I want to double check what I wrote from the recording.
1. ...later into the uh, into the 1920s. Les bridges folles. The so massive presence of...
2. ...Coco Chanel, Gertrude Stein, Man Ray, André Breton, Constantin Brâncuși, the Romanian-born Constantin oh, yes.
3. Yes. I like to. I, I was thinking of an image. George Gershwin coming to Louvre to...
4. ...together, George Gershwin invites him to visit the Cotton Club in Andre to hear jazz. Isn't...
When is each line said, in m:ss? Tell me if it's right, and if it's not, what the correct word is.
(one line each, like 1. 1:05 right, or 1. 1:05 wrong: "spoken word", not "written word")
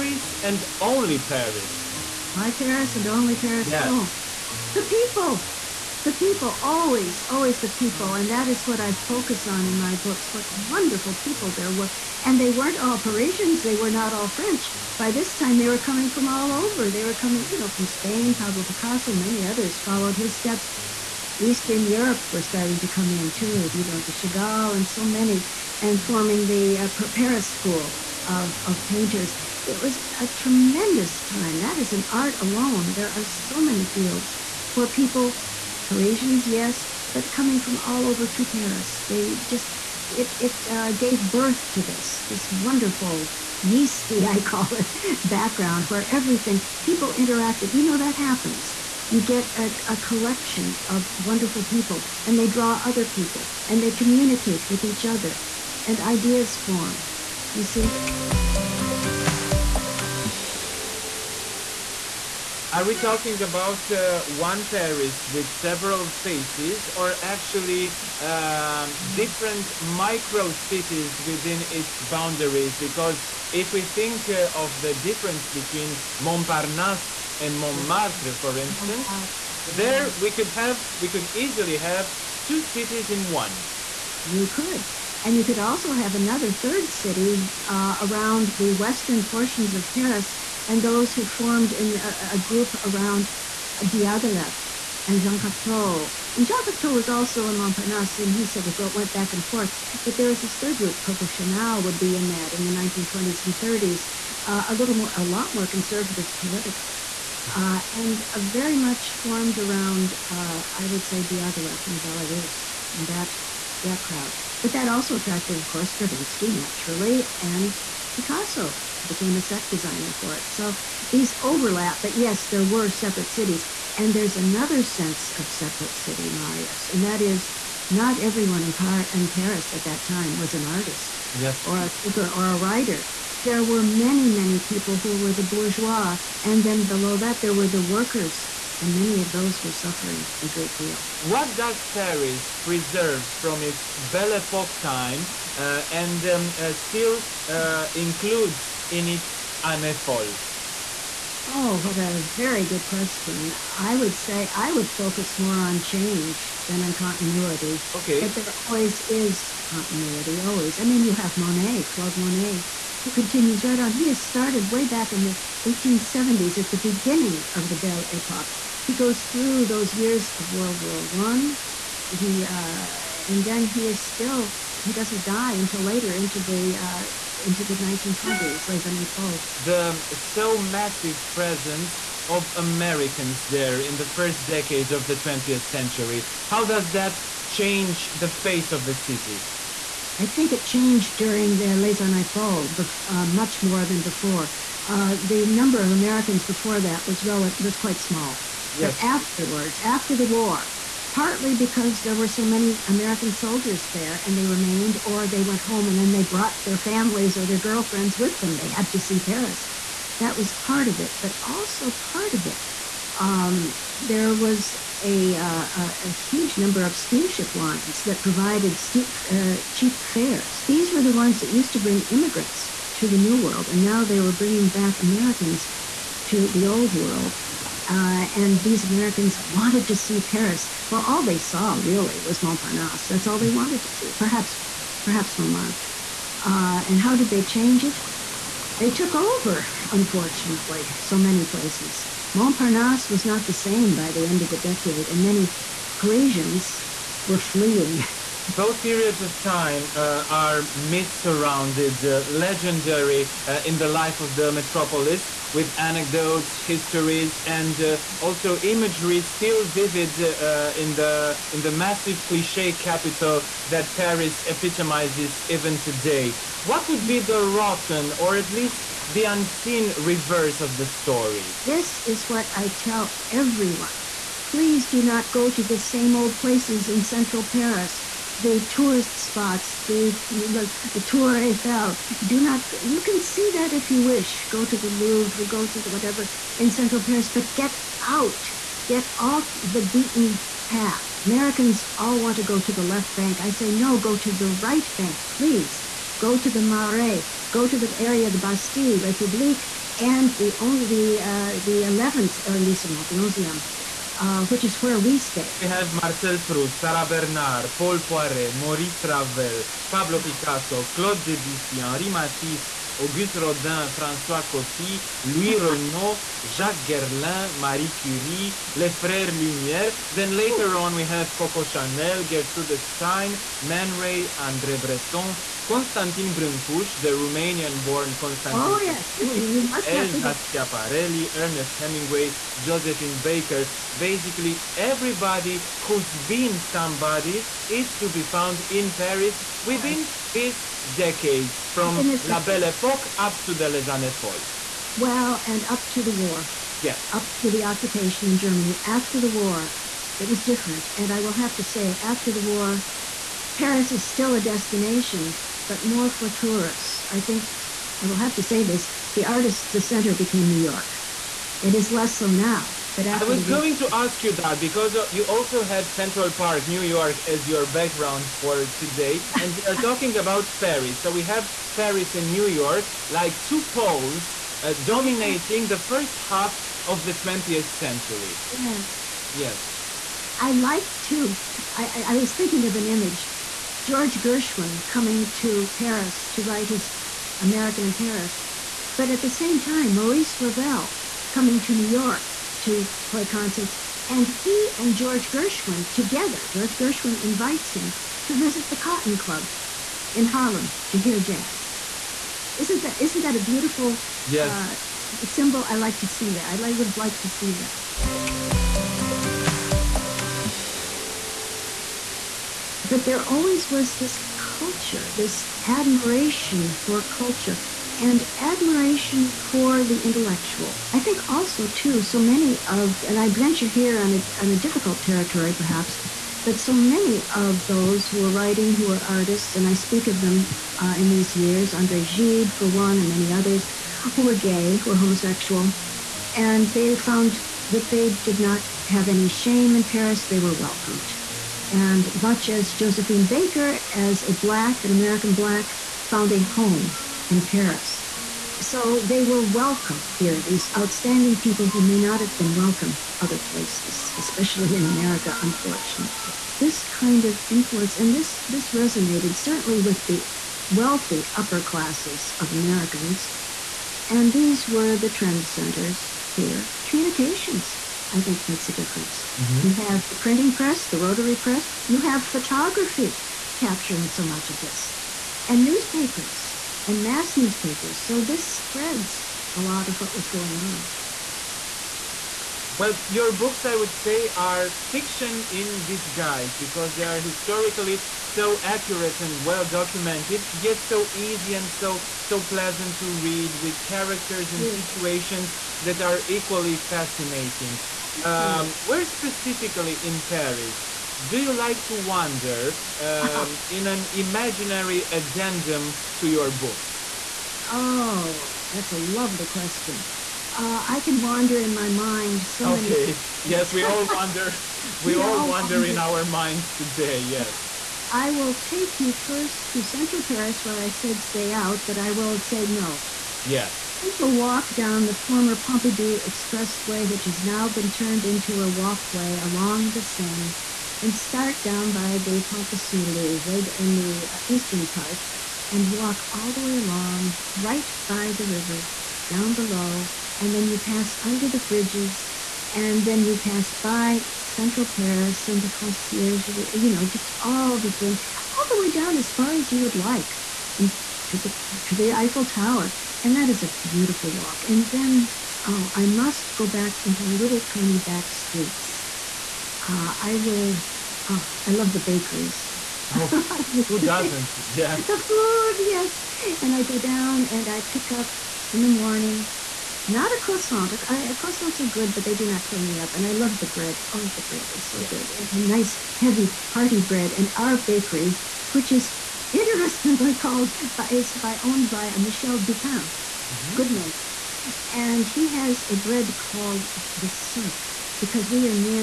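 1. 2:55 wrong: "années", not "bridges"
2. 5:21 right
3. 6:19 wrong: "Paris", not "Louvre"
4. 6:35 wrong: "Harlem", not "Andre".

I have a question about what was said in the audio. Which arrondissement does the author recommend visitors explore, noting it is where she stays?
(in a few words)
11th arrondissement.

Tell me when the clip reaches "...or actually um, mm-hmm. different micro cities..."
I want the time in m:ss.
1:06.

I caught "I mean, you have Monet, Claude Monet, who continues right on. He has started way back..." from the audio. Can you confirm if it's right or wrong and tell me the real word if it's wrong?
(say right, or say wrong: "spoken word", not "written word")
right.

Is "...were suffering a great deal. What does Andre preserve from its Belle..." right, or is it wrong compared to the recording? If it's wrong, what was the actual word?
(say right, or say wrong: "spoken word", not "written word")
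wrong: "Paris", not "Andre".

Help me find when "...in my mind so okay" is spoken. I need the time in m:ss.
8:31.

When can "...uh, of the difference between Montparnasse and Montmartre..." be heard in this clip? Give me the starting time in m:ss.
1:14.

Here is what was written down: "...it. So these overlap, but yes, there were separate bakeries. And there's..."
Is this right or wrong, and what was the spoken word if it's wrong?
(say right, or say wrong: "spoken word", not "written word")
wrong: "cities", not "bakeries".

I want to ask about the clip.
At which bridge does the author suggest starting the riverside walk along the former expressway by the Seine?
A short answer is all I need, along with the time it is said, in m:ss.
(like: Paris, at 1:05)
Pont de Sully, at 8:52.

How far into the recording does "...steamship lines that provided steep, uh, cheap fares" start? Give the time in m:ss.
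3:36.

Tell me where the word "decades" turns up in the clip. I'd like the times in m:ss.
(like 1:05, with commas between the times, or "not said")
3:04, 4:04, 5:40.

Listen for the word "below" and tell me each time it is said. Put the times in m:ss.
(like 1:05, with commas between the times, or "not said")
2:16, 8:59.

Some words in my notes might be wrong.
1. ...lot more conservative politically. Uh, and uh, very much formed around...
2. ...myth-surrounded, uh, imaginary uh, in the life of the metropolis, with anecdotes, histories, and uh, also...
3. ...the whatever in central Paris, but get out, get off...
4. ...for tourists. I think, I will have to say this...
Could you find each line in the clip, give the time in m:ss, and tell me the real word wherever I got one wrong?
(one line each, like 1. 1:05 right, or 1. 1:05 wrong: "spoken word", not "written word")
1. 1:45 right
2. 4:10 wrong: "legendary", not "imaginary"
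3. 4:45 right
4. 5:56 right.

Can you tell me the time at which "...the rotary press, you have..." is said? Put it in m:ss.
7:50.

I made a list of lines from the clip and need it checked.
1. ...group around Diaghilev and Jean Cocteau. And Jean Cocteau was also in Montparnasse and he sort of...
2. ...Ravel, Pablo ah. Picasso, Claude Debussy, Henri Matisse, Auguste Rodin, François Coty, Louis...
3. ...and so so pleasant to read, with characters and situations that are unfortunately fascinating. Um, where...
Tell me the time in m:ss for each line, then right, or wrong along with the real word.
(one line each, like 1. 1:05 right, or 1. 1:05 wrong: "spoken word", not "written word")
1. 1:32 right
2. 5:09 right
3. 8:11 wrong: "equally", not "unfortunately".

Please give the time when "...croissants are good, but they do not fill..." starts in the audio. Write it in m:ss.
9:31.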